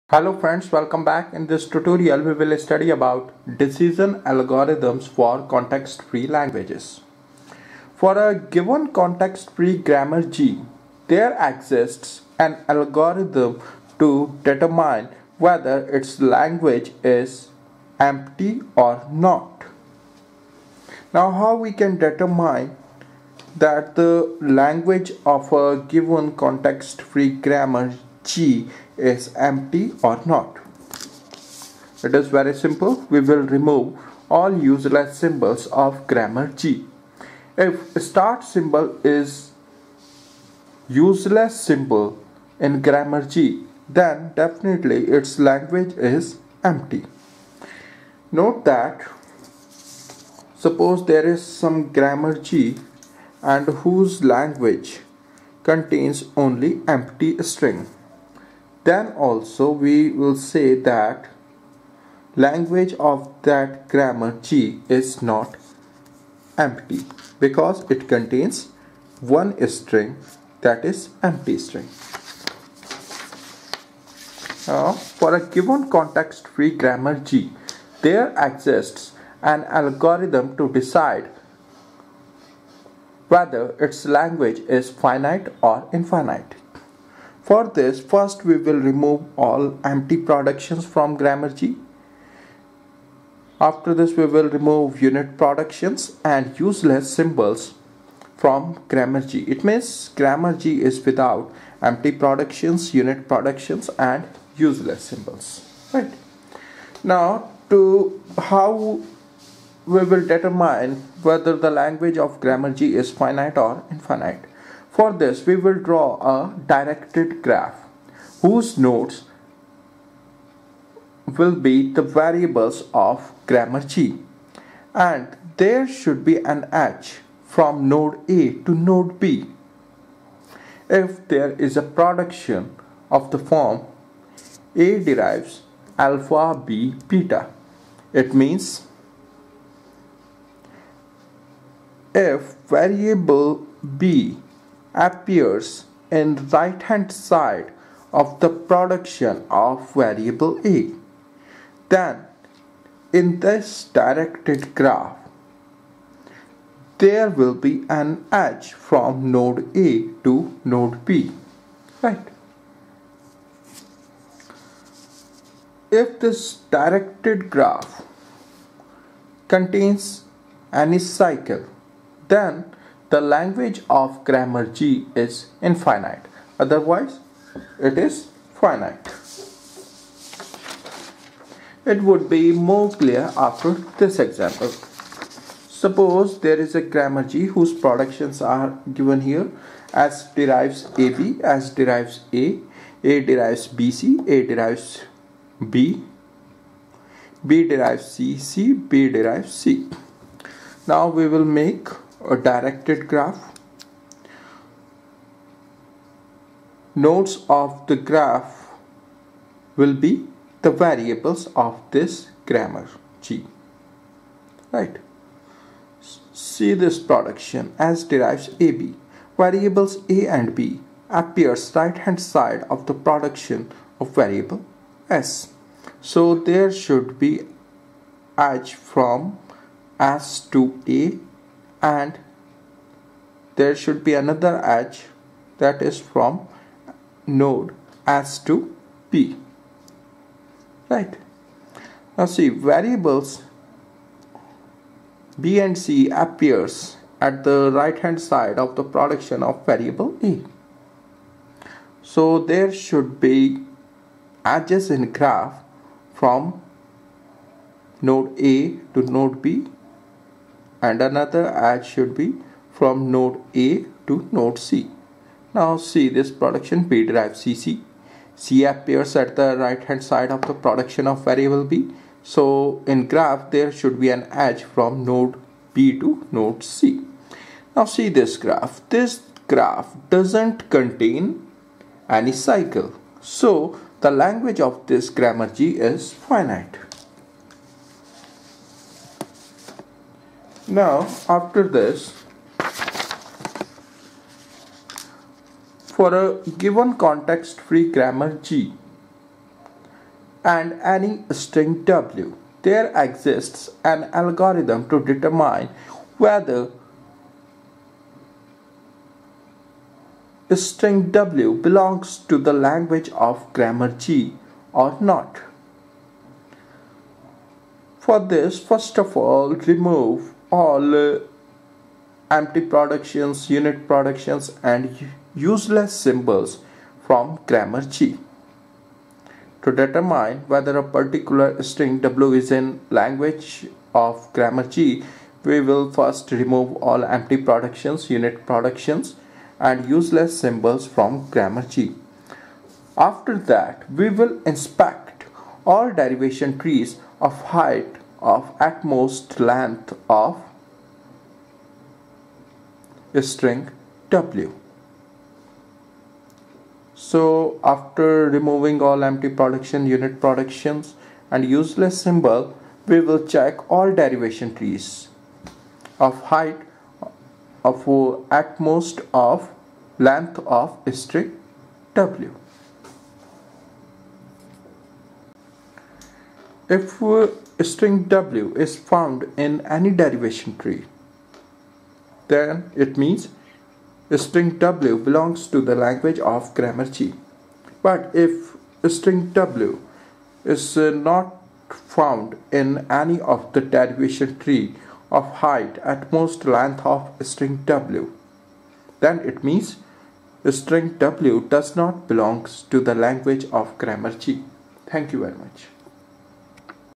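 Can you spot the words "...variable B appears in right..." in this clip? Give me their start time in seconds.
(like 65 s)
142 s.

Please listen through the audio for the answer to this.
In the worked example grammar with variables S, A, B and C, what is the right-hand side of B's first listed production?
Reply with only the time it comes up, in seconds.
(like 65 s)
198 s.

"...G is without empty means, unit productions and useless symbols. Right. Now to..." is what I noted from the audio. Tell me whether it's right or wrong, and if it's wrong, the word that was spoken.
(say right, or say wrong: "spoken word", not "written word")
wrong: "productions", not "means".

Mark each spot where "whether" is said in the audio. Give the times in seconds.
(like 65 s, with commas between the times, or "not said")
15 s, 83 s, 111 s, 306 s, 330 s.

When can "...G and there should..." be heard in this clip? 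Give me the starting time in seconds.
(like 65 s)
123 s.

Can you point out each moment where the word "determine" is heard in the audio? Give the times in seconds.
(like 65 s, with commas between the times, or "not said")
14 s, 21 s, 110 s, 305 s, 329 s.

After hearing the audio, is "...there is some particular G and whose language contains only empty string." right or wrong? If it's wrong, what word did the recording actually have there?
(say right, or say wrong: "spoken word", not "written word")
wrong: "grammar", not "particular".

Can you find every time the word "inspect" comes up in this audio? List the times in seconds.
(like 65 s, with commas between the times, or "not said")
344 s.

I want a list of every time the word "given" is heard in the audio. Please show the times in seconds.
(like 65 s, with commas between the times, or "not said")
8 s, 25 s, 75 s, 188 s, 296 s.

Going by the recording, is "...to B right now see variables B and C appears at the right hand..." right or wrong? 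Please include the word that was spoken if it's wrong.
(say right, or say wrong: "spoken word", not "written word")
right.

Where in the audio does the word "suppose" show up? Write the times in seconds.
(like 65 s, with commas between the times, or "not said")
50 s, 185 s.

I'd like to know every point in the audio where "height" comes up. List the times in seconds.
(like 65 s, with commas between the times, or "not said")
347 s, 366 s, 395 s.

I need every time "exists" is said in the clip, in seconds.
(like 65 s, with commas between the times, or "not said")
11 s, 78 s, 302 s.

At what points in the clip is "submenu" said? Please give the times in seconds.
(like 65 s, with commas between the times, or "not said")
not said.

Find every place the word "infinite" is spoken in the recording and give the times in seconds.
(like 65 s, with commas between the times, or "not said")
85 s, 113 s, 175 s.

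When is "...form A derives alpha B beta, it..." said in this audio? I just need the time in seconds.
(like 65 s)
133 s.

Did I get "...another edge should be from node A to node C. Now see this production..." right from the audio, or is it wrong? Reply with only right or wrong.
right.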